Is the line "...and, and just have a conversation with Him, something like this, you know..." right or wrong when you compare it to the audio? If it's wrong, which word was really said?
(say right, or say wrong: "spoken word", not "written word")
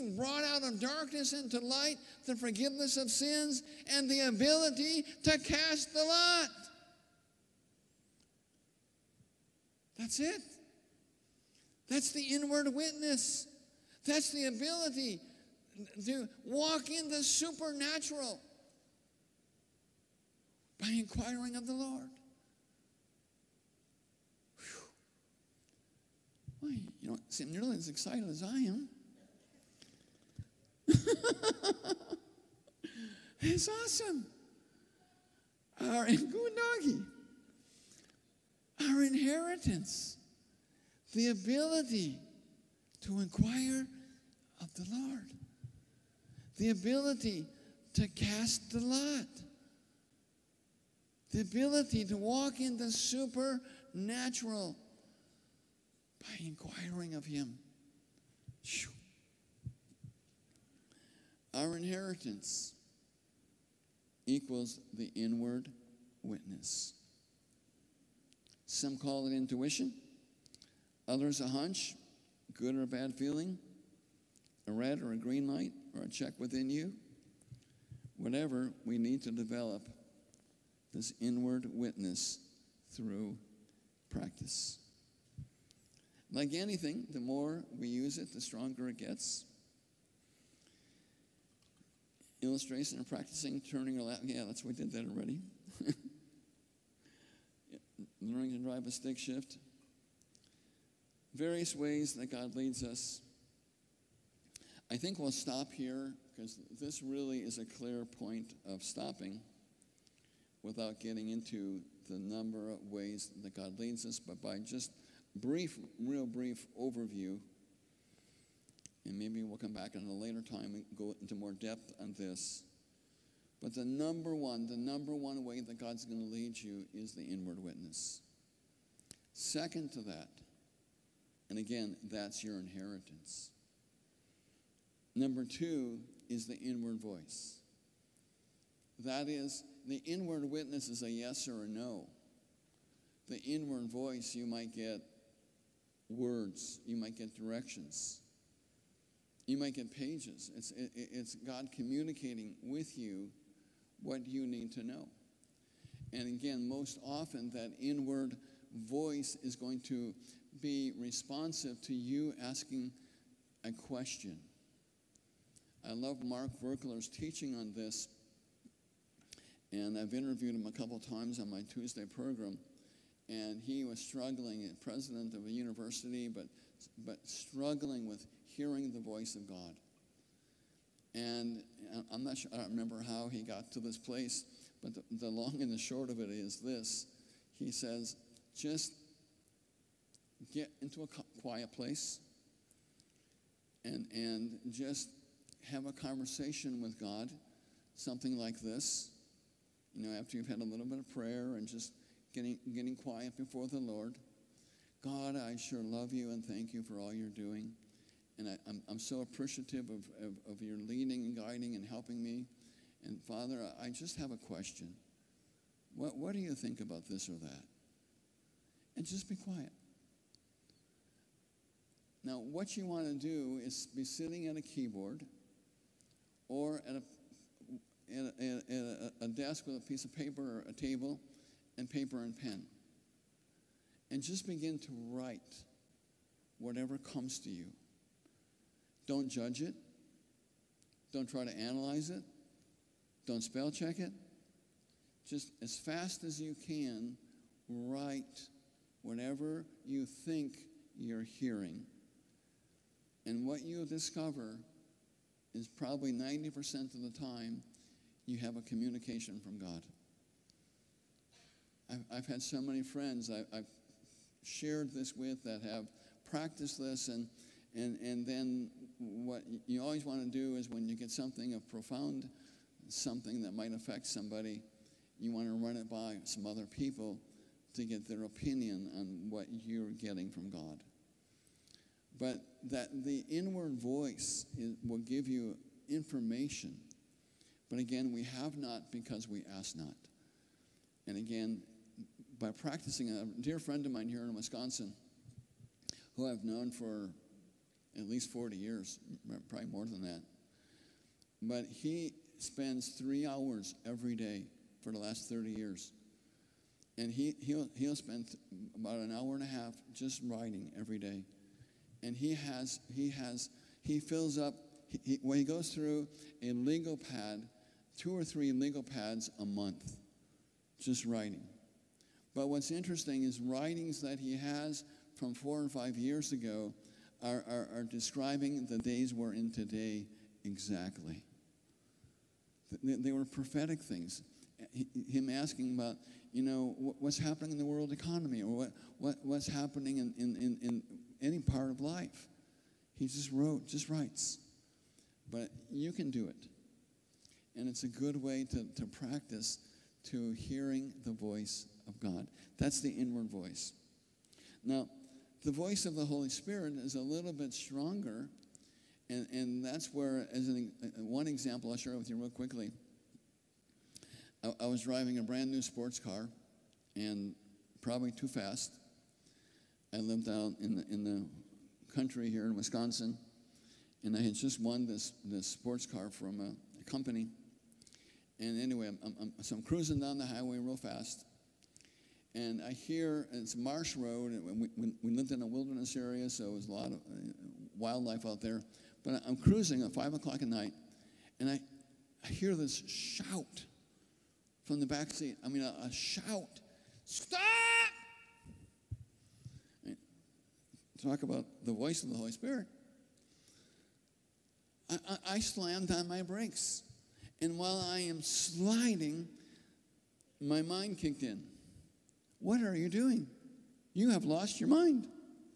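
wrong: "God", not "Him".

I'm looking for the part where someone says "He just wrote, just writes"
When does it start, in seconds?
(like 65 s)
342 s.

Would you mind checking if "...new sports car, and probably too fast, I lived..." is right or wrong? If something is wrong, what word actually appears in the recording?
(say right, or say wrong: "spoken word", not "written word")
right.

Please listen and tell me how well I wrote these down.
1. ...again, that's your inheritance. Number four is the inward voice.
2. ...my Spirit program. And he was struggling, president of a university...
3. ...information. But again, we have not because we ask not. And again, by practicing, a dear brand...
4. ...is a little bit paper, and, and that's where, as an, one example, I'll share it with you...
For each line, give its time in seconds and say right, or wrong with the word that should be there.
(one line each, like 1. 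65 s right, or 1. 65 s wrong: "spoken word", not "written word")
1. 131 s wrong: "two", not "four"
2. 171 s wrong: "Tuesday", not "Spirit"
3. 285 s wrong: "friend", not "brand"
4. 356 s wrong: "stronger", not "paper".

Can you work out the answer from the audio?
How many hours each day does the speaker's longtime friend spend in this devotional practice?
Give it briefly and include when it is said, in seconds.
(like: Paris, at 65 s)
3, at 302 s.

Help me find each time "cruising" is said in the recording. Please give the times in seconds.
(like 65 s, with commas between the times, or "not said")
379 s, 389 s.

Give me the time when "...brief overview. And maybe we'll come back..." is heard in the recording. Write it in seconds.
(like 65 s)
116 s.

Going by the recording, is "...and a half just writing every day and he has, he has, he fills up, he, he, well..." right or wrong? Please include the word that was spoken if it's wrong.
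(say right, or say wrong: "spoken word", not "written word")
right.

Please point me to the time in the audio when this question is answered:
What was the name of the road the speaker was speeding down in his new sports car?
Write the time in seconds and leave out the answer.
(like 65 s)
383 s.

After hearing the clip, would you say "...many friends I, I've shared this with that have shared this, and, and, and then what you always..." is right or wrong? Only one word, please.
wrong.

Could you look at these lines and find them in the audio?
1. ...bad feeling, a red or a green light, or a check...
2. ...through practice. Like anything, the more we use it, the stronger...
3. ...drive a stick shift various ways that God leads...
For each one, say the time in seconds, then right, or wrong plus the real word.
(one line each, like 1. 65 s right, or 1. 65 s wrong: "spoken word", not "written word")
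1. 72 s right
2. 82 s right
3. 98 s right.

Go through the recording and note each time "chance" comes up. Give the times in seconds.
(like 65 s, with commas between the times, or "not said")
not said.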